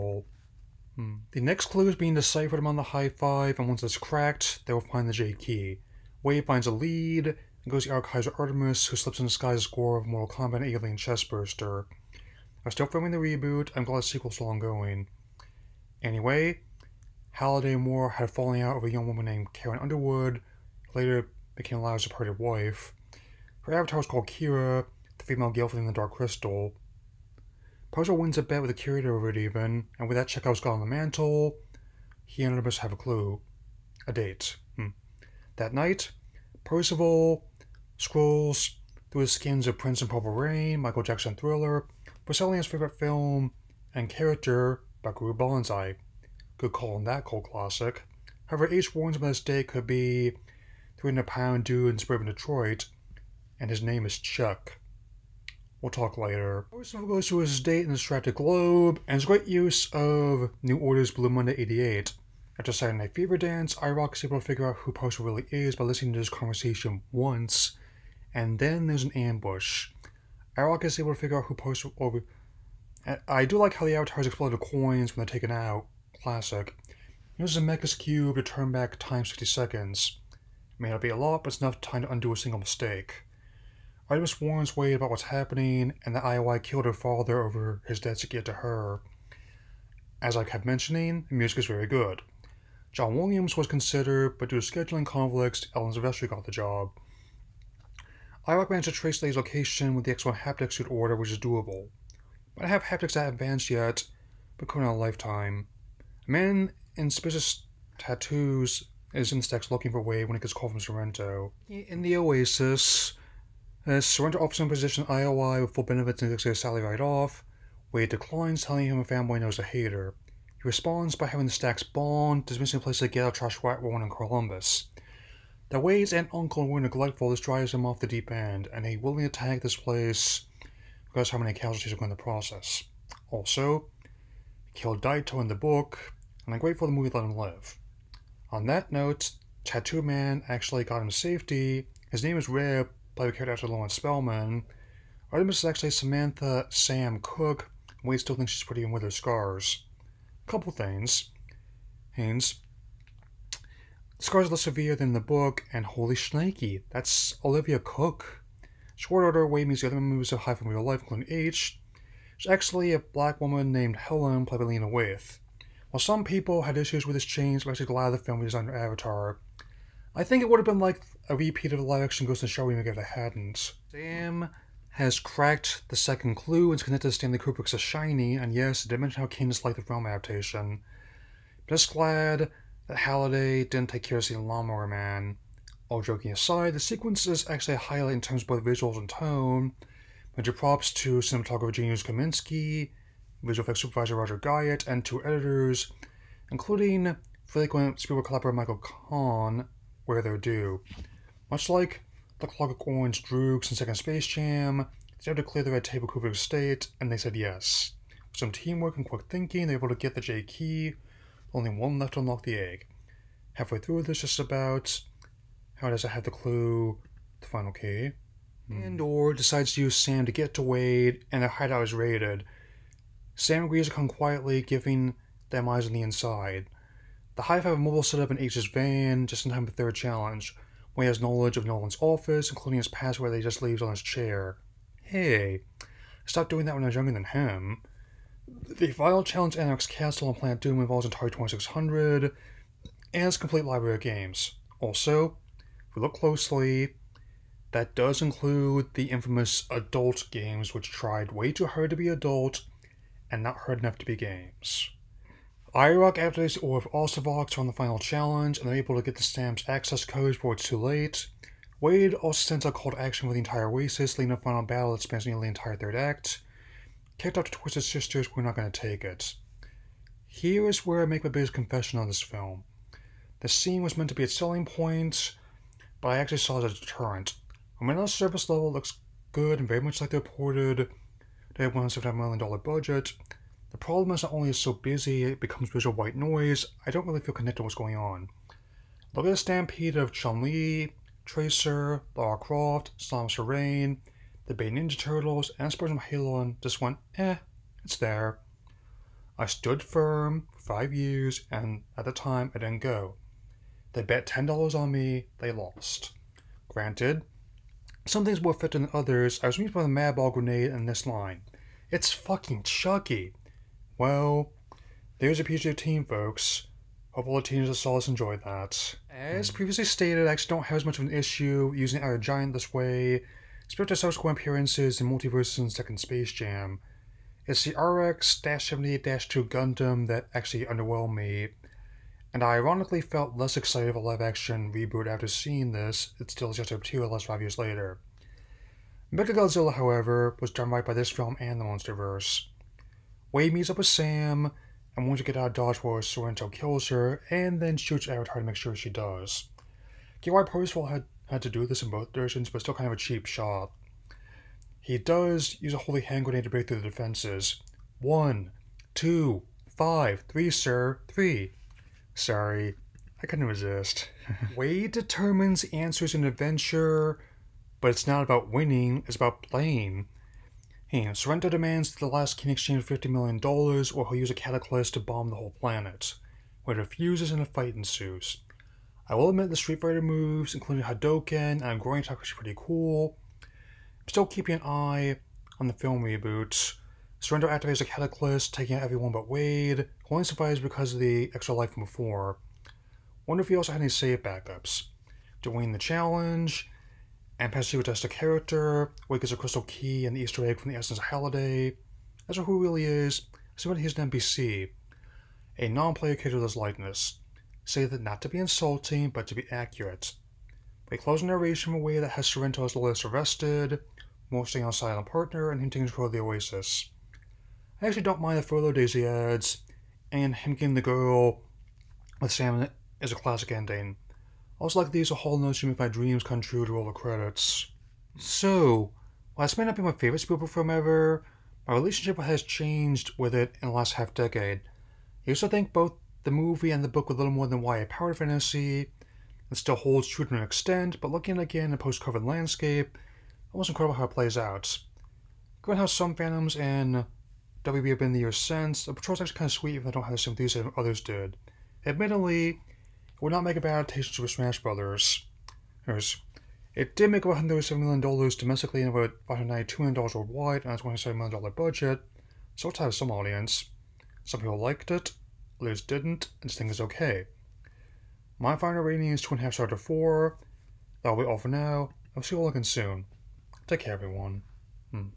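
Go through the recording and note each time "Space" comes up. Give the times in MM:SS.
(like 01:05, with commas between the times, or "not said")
03:23, 05:25.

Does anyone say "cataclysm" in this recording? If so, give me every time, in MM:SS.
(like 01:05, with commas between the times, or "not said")
06:14, 06:27.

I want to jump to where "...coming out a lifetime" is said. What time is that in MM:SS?
01:44.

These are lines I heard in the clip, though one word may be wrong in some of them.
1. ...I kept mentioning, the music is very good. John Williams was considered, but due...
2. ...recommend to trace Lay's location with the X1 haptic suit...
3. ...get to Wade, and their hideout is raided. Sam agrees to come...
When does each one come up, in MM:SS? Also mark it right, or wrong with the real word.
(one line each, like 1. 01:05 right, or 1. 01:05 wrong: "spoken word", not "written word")
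1. 01:30 right
2. 01:38 right
3. 03:40 right.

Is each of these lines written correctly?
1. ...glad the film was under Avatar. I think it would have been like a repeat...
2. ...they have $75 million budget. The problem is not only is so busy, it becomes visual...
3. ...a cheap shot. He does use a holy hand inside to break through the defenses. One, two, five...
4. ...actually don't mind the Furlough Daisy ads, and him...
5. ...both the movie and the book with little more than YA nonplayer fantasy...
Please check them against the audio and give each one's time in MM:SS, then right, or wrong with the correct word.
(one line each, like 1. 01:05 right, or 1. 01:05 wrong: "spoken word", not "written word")
1. 02:47 right
2. 04:41 right
3. 05:52 wrong: "grenade", not "inside"
4. 06:57 right
5. 07:15 wrong: "power", not "nonplayer".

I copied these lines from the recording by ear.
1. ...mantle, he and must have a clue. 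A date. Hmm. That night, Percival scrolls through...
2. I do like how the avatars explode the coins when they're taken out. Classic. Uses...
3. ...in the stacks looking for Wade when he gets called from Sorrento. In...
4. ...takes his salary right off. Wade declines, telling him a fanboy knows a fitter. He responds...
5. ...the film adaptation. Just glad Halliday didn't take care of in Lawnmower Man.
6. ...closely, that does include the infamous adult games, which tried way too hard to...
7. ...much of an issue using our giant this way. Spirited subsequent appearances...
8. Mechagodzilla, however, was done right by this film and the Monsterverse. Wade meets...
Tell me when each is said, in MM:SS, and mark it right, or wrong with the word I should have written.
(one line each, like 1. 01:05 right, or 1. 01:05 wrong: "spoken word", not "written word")
1. 00:30 right
2. 01:13 right
3. 01:49 right
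4. 01:56 wrong: "hater", not "fitter"
5. 02:59 right
6. 04:06 right
7. 05:20 right
8. 05:39 right.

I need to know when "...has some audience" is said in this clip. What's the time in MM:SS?
07:42.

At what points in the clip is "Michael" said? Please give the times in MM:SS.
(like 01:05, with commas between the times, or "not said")
00:40, 03:18.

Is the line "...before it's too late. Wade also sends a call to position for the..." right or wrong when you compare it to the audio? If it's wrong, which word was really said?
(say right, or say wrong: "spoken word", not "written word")
wrong: "action", not "position".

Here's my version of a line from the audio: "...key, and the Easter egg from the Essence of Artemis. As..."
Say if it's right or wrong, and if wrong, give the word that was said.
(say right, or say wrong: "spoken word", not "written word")
wrong: "Halliday", not "Artemis".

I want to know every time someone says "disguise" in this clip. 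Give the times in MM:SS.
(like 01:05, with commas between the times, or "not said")
00:09.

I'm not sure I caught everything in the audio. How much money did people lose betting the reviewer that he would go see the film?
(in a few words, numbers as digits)
$10.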